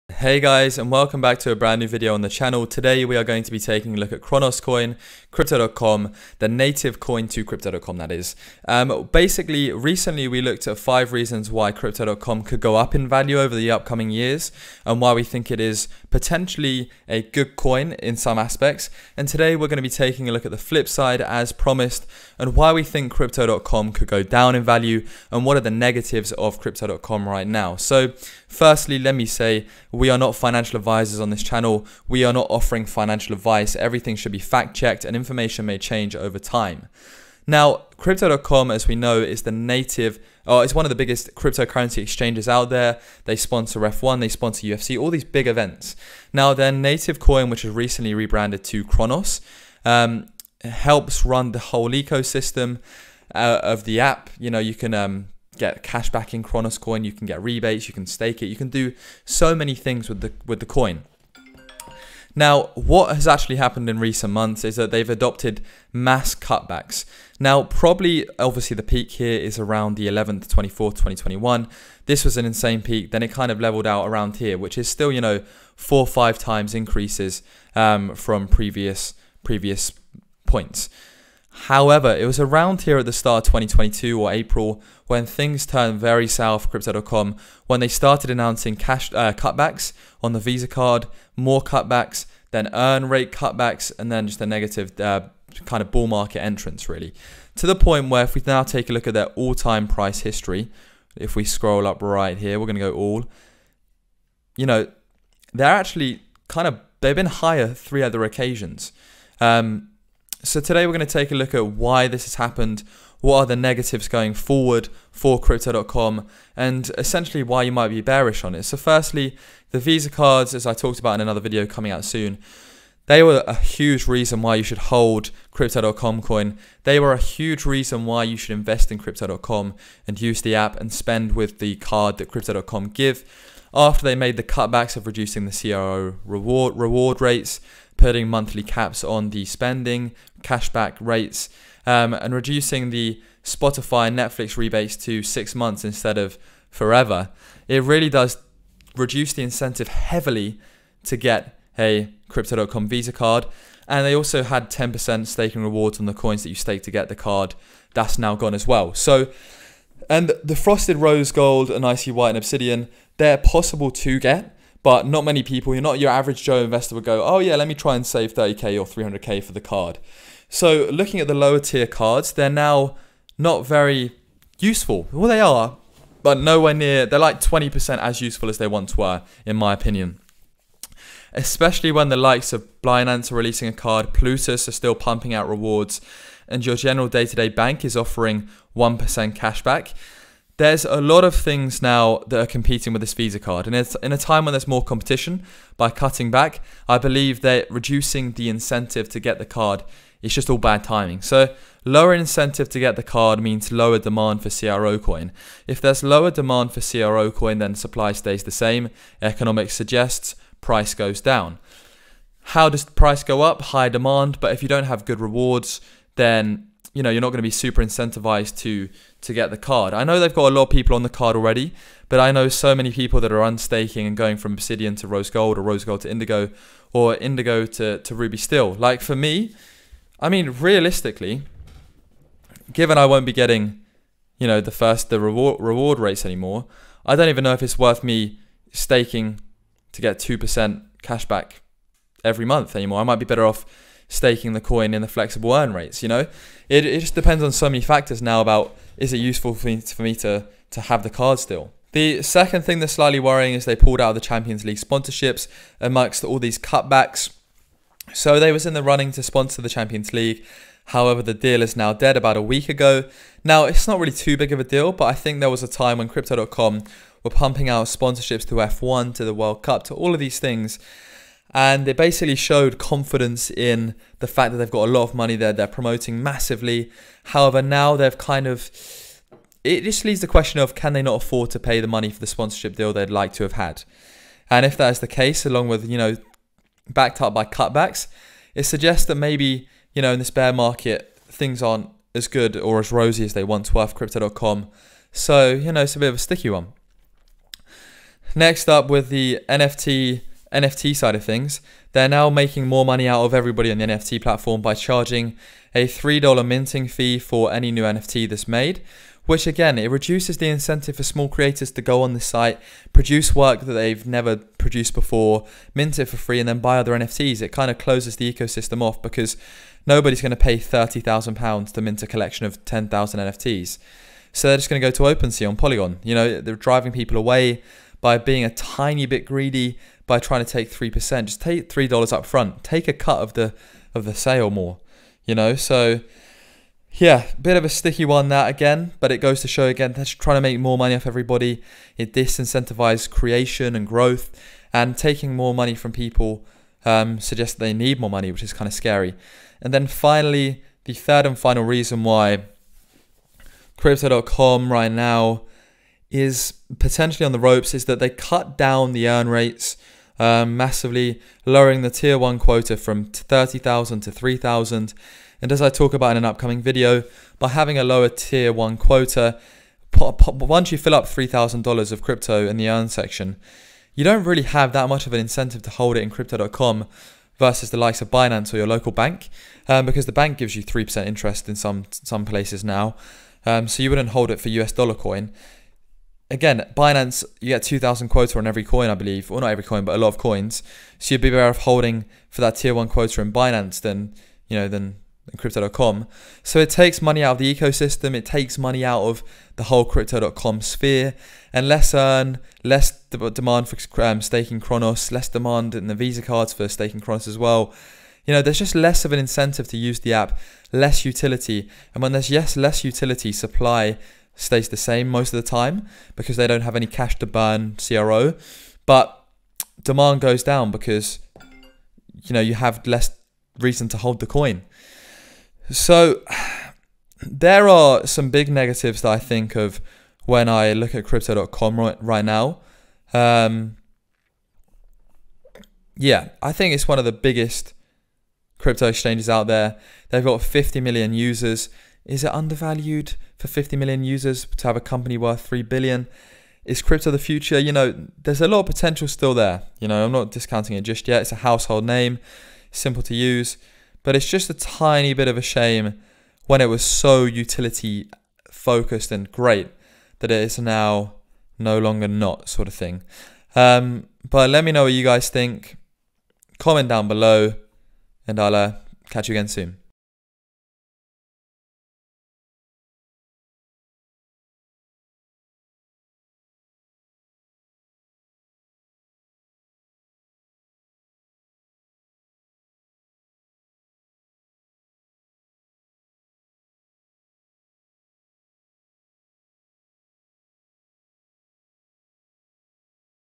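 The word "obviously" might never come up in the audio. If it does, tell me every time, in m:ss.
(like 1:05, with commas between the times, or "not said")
1:08.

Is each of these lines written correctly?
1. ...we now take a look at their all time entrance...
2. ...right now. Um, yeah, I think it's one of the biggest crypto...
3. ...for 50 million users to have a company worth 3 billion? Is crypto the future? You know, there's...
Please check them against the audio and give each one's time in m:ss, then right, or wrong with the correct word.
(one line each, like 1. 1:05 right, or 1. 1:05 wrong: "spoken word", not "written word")
1. 1:38 wrong: "price", not "entrance"
2. 7:12 right
3. 7:23 right.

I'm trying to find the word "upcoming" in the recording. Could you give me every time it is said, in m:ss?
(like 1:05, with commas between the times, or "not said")
0:13, 6:06.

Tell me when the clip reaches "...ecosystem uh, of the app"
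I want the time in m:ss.
0:51.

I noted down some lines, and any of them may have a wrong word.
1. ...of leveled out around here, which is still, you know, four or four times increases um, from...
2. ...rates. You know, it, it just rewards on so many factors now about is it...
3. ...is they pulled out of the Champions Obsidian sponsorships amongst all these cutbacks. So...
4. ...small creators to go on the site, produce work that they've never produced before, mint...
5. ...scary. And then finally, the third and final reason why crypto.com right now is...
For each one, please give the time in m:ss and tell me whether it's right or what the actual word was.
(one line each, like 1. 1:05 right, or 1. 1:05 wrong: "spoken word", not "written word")
1. 1:13 wrong: "five", not "four"
2. 4:05 wrong: "depends", not "rewards"
3. 4:13 wrong: "League", not "Obsidian"
4. 5:11 right
5. 5:48 right.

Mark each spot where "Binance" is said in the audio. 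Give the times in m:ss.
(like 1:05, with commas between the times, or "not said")
3:02, 6:18, 6:26, 6:33.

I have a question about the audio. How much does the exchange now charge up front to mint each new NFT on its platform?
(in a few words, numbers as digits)
$3.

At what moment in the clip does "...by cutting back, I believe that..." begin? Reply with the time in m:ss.
3:15.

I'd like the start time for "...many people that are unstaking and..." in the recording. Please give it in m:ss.
3:42.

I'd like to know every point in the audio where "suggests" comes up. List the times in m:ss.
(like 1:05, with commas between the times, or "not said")
3:29, 4:48, 5:47.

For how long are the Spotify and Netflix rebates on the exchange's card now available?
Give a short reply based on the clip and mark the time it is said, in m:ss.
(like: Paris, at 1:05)
6 months, at 2:25.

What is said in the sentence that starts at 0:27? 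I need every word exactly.
So firstly, let me say we are not financial advisors on this channel.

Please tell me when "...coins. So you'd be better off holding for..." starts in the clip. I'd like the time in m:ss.
6:30.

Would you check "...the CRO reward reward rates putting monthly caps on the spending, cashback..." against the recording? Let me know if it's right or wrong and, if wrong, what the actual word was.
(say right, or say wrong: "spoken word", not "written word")
right.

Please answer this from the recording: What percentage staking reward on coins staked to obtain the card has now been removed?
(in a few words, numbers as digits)
10%.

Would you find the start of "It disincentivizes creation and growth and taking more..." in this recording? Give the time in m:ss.
5:41.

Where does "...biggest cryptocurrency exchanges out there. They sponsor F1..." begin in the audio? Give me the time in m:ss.
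0:40.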